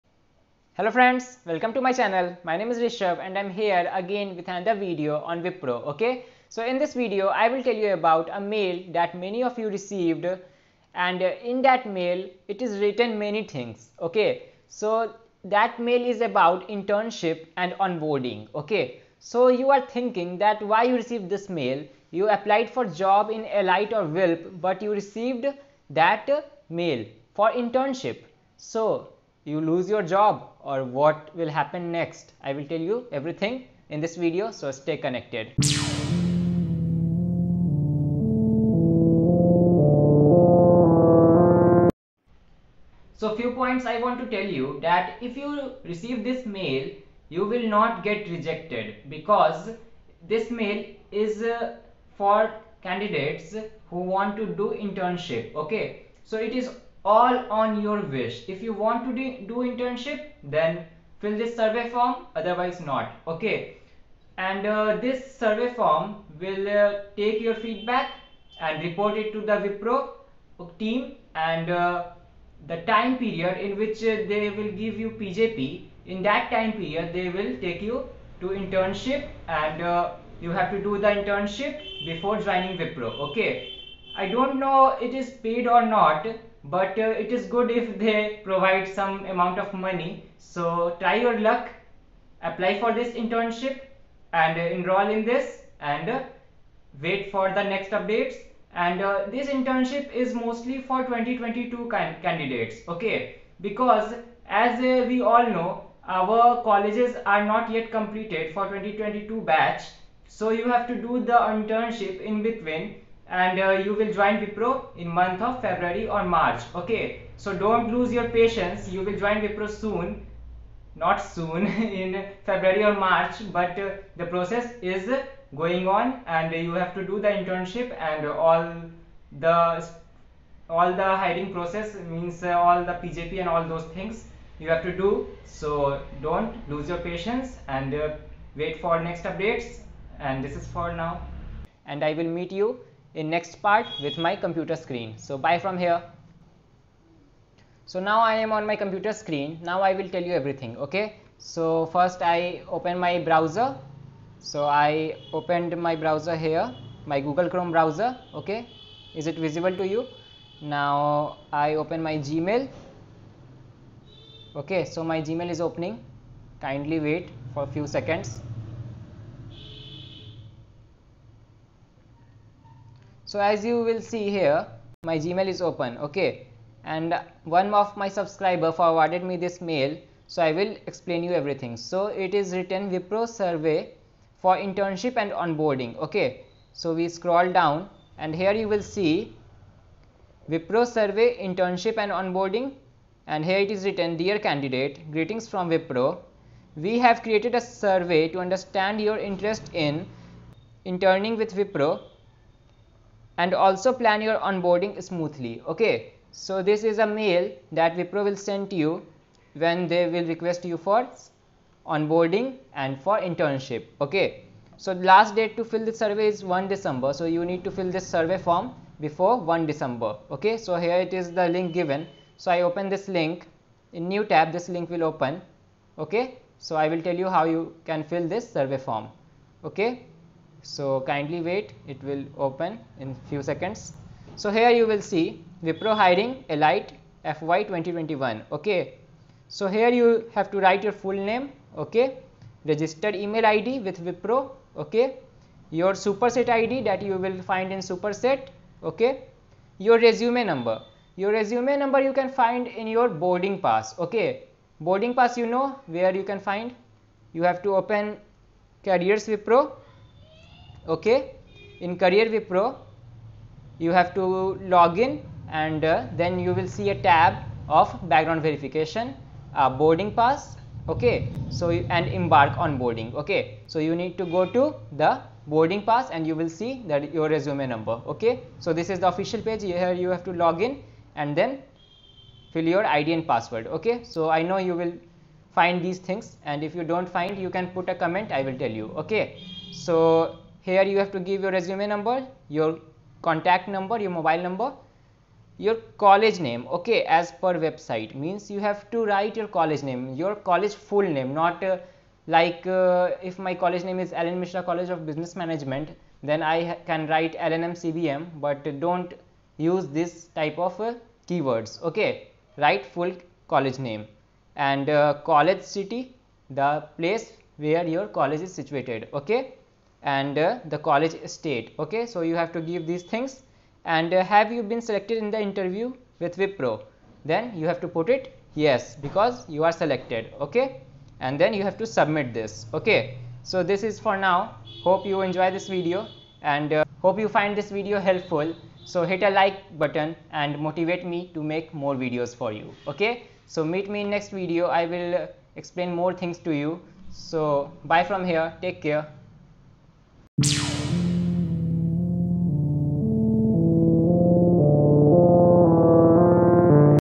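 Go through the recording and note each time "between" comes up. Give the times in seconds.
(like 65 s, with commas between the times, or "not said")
112 s.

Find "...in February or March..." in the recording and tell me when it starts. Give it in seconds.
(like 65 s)
122 s.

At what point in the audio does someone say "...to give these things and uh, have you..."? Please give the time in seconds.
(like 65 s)
322 s.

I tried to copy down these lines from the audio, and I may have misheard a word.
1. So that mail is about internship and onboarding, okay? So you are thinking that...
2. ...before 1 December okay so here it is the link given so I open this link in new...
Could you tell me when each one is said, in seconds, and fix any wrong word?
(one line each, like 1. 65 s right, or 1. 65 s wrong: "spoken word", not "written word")
1. 14 s right
2. 219 s right.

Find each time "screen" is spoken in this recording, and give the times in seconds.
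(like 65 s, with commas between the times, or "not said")
144 s, 149 s.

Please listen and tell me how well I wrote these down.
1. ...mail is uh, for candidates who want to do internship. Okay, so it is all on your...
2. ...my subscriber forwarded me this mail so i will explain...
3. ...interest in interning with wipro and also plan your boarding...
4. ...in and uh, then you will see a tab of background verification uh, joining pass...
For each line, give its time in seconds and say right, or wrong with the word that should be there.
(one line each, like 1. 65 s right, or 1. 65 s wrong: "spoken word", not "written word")
1. 50 s right
2. 178 s right
3. 199 s wrong: "onboarding", not "boarding"
4. 264 s wrong: "boarding", not "joining".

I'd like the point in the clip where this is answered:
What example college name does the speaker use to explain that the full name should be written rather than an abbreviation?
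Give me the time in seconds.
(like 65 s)
304 s.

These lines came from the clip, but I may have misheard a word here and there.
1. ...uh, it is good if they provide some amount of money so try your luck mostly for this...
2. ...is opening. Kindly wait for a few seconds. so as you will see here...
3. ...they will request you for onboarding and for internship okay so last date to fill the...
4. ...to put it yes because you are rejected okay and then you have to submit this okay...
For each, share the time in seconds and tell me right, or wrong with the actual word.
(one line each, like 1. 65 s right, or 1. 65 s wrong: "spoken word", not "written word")
1. 86 s wrong: "apply", not "mostly"
2. 165 s right
3. 209 s right
4. 327 s wrong: "selected", not "rejected".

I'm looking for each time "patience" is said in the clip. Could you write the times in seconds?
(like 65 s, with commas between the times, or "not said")
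118 s, 136 s.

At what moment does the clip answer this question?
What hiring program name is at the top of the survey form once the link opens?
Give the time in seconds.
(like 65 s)
235 s.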